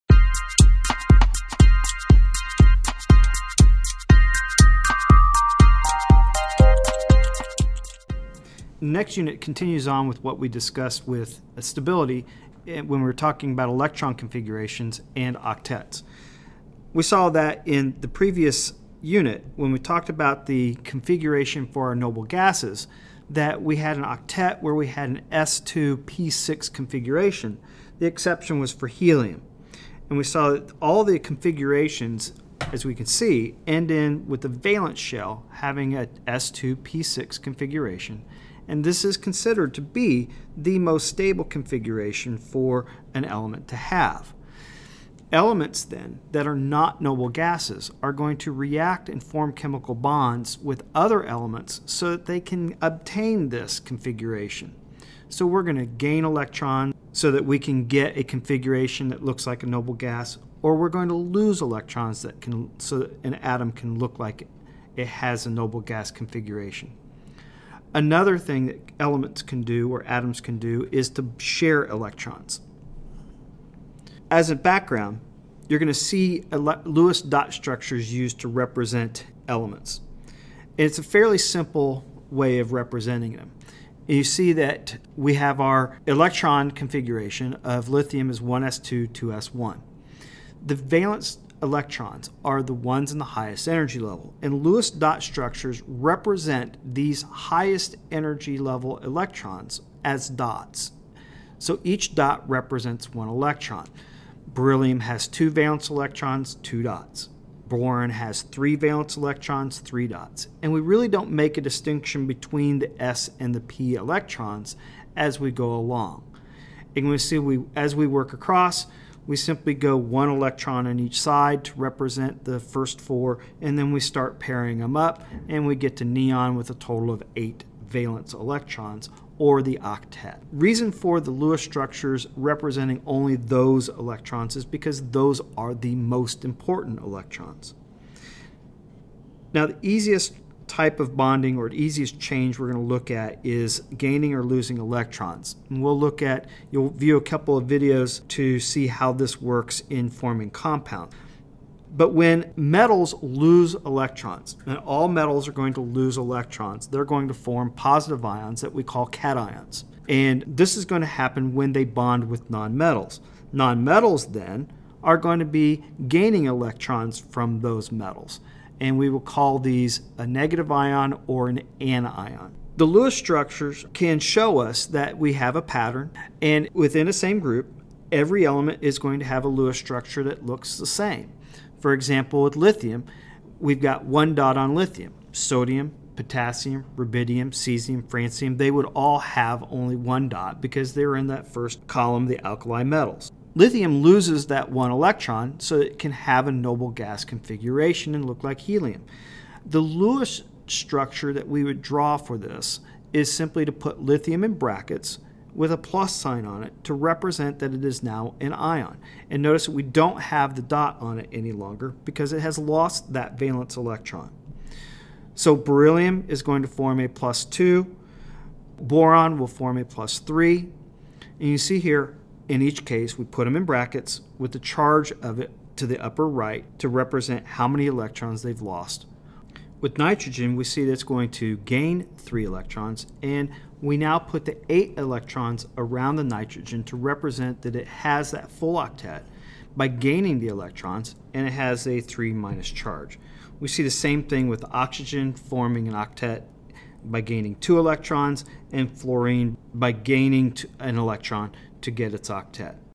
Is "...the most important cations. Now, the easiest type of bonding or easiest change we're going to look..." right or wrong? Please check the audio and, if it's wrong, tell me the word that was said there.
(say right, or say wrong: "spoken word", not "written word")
wrong: "electrons", not "cations".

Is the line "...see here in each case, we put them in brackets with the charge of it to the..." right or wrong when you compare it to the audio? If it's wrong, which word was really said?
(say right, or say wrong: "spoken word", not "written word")
right.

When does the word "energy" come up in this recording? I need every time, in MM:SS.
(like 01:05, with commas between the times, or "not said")
01:33, 01:38.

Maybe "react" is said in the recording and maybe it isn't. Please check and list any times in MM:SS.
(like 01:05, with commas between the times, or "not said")
00:48.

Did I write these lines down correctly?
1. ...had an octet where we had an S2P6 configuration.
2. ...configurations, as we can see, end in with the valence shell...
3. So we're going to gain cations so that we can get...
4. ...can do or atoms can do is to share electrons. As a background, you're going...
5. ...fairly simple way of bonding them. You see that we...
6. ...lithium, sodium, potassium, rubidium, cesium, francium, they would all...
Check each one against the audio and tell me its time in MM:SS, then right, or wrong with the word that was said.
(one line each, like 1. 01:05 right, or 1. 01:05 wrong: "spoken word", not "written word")
1. 00:23 right
2. 00:31 right
3. 00:55 wrong: "electrons", not "cations"
4. 01:09 right
5. 01:21 wrong: "representing", not "bonding"
6. 03:04 right.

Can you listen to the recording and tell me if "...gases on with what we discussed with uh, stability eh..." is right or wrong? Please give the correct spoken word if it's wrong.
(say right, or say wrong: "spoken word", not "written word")
wrong: "continues", not "gases".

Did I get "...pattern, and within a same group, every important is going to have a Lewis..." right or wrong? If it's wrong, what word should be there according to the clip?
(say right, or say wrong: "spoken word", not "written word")
wrong: "element", not "important".